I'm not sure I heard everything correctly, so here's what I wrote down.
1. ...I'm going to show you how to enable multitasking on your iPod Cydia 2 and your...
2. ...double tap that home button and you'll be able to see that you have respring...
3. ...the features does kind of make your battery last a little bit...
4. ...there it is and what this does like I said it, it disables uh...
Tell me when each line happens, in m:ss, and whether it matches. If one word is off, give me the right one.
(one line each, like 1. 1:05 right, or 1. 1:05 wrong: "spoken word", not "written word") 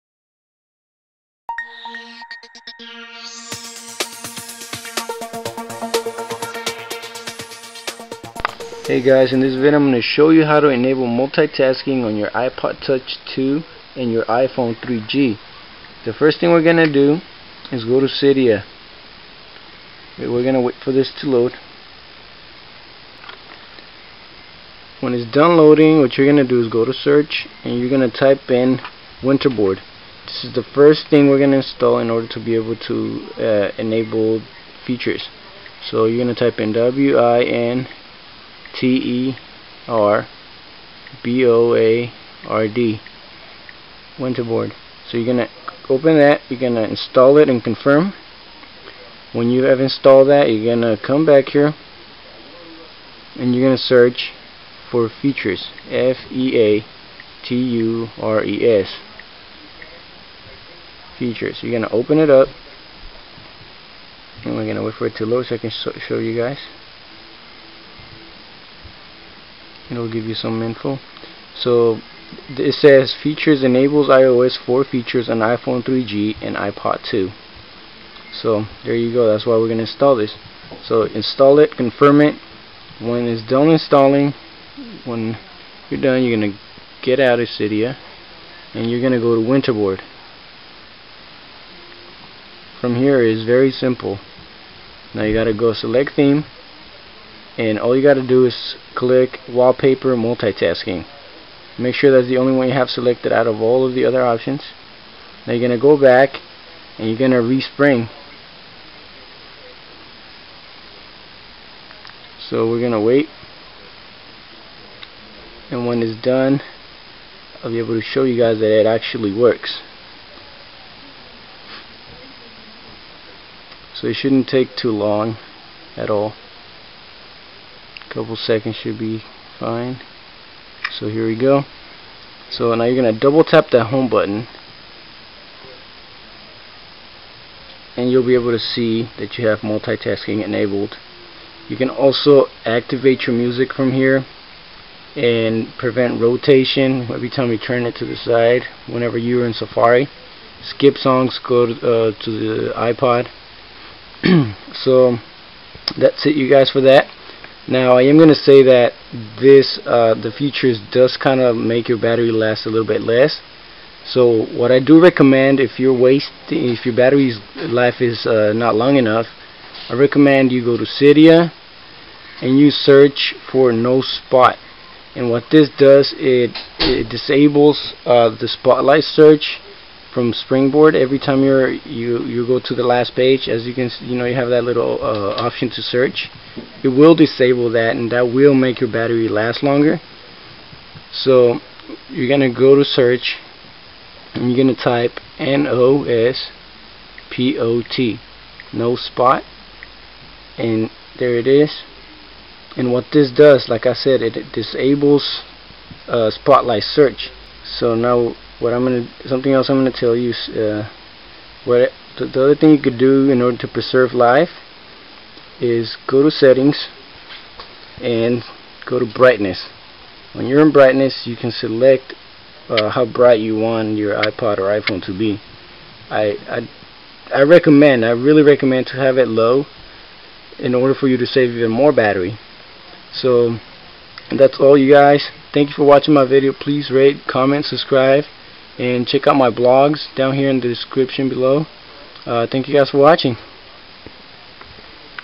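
1. 0:09 wrong: "Touch", not "Cydia"
2. 2:13 wrong: "multitasking", not "respring"
3. 2:40 right
4. 3:21 right.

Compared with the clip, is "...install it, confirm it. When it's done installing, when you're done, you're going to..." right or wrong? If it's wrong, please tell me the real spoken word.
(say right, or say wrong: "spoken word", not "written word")
right.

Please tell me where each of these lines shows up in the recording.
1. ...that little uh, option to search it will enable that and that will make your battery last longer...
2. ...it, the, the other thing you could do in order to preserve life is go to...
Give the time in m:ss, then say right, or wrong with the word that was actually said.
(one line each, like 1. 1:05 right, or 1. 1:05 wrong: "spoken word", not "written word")
1. 3:04 wrong: "disable", not "enable"
2. 3:31 right.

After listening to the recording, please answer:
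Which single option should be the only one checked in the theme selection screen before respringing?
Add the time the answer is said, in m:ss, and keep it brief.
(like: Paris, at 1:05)
wallpaper multitasking, at 1:39.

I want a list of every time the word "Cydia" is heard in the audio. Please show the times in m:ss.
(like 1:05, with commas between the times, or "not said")
0:18, 1:27, 2:50.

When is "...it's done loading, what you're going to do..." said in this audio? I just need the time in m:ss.
0:25.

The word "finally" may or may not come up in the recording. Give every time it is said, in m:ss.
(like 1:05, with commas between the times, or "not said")
not said.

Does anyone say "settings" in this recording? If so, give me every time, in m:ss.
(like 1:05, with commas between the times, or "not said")
3:36.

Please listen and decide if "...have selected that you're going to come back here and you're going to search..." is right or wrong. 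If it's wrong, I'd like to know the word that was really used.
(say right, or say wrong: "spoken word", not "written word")
wrong: "installed", not "selected".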